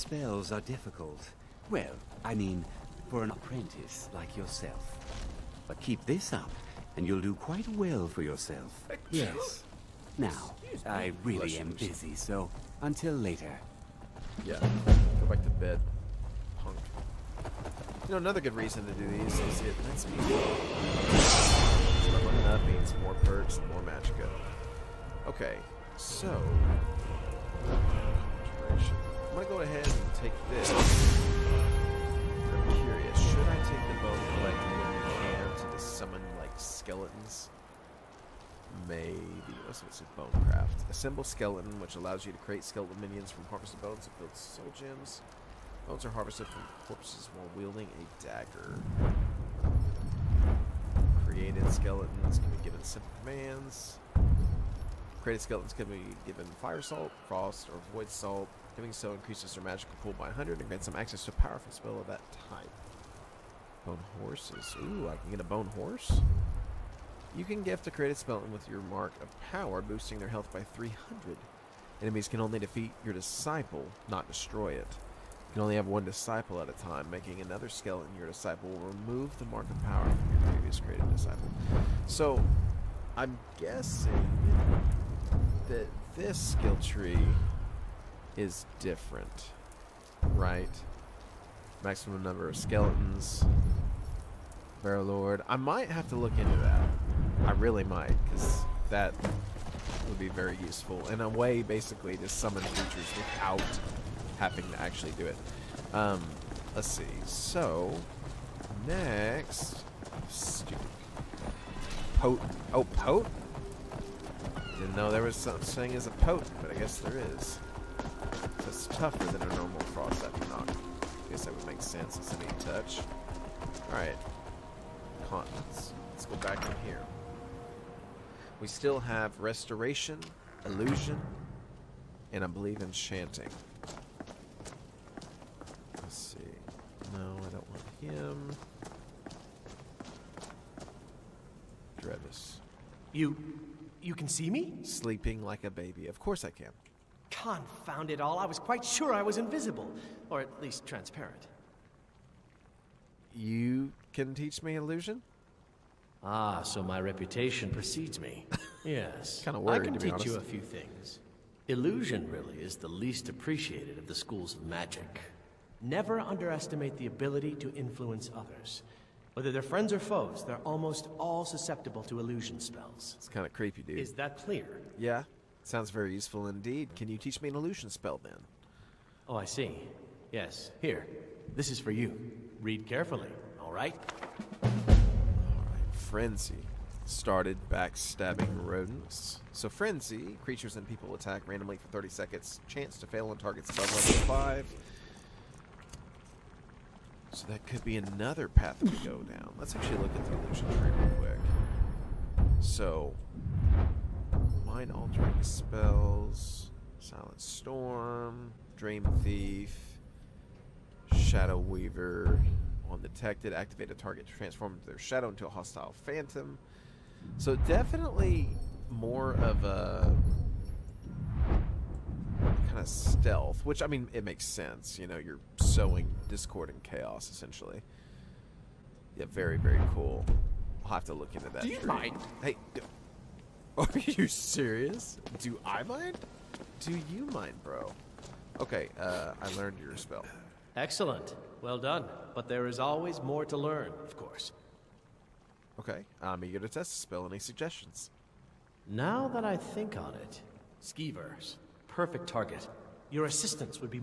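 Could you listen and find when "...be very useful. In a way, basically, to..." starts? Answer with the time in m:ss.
1:40.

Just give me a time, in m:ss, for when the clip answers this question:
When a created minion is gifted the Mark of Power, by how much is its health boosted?
1:10.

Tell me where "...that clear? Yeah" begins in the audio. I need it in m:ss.
2:54.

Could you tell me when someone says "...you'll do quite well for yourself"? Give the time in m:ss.
0:07.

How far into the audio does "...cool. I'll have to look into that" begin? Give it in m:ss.
3:49.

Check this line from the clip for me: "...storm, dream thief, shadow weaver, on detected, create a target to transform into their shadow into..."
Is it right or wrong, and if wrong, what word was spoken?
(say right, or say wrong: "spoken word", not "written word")
wrong: "activate", not "create".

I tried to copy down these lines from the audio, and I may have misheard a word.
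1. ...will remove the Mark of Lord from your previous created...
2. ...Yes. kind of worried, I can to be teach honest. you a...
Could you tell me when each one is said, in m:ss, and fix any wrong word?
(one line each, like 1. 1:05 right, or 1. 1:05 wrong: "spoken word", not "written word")
1. 1:18 wrong: "Power", not "Lord"
2. 2:38 right.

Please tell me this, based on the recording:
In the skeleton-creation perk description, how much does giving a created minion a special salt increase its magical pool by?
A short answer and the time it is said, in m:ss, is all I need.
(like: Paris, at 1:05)
100, at 1:00.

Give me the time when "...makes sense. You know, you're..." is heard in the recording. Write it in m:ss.
3:44.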